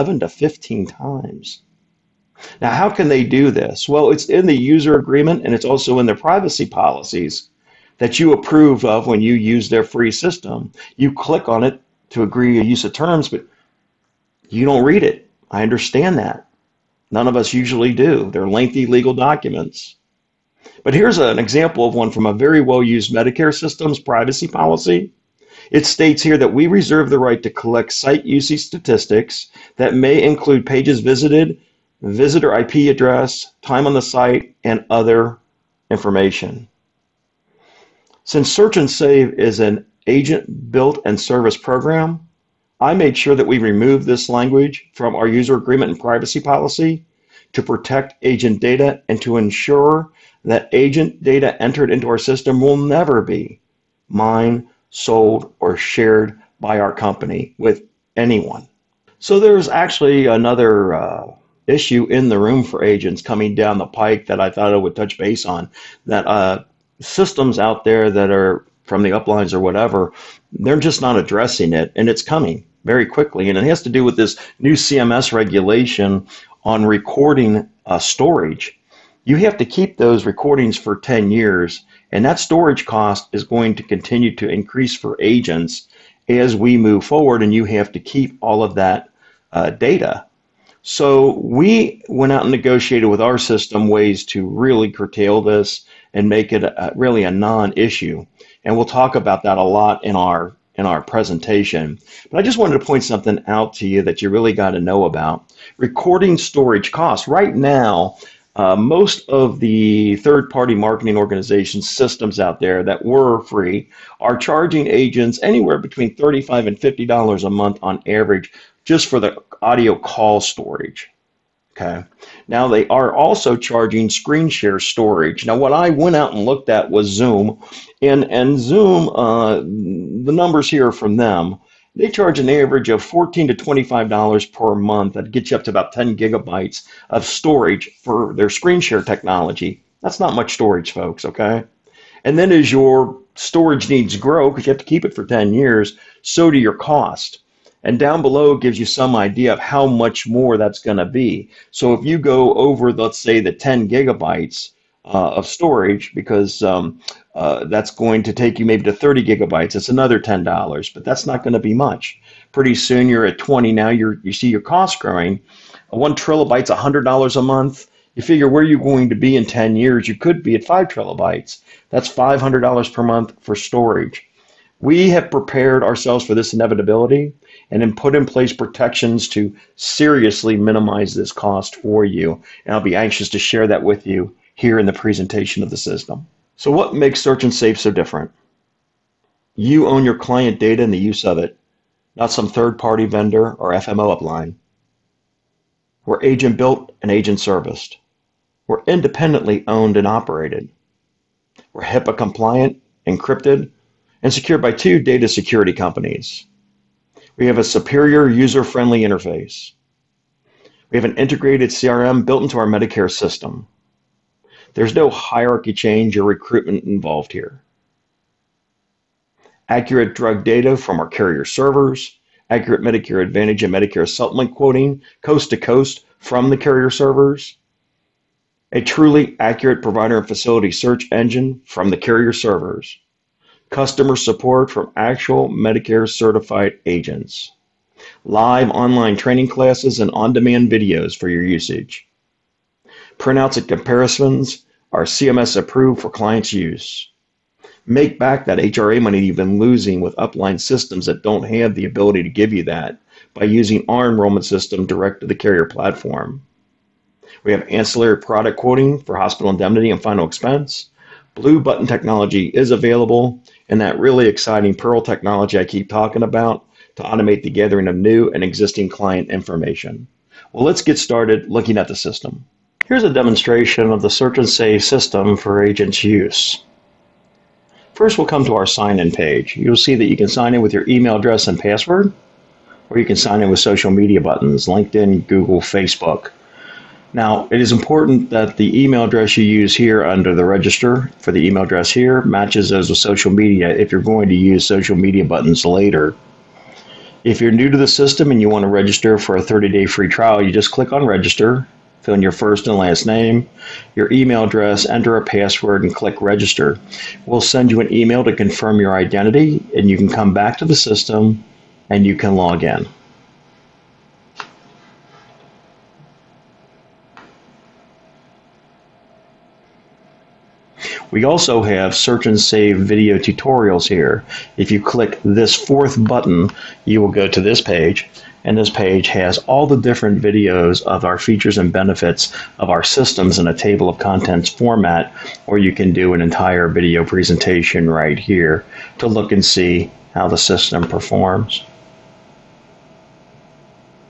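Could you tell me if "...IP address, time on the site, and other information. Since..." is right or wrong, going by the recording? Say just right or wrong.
right.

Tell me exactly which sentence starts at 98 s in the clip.
And we'll talk about that a lot in our in our presentation.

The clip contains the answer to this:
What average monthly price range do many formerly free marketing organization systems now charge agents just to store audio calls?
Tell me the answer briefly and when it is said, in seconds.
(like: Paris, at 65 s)
$35 to $50, at 115 s.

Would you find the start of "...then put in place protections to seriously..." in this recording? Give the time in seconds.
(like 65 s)
177 s.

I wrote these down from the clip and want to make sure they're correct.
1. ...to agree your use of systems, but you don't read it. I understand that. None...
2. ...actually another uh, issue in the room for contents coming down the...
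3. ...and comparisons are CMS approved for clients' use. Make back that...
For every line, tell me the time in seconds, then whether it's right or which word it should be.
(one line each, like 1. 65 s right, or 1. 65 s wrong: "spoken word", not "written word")
1. 12 s wrong: "terms", not "systems"
2. 59 s wrong: "agents", not "contents"
3. 243 s right.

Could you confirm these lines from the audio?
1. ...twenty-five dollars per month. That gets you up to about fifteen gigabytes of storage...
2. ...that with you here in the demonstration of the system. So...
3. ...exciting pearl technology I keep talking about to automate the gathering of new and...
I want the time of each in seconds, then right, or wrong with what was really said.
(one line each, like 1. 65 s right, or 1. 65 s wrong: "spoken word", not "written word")
1. 133 s wrong: "ten", not "fifteen"
2. 183 s wrong: "presentation", not "demonstration"
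3. 264 s right.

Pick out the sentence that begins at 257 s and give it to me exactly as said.
We have ancillary product quoting for hospital indemnity and final expense.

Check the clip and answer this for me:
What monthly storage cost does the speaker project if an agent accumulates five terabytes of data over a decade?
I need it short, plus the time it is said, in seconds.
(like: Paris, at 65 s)
$500, at 172 s.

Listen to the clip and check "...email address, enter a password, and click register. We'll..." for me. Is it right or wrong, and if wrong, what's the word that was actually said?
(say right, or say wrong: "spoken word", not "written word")
right.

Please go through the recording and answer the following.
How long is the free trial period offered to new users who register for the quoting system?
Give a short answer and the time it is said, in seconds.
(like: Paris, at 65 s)
30 days, at 299 s.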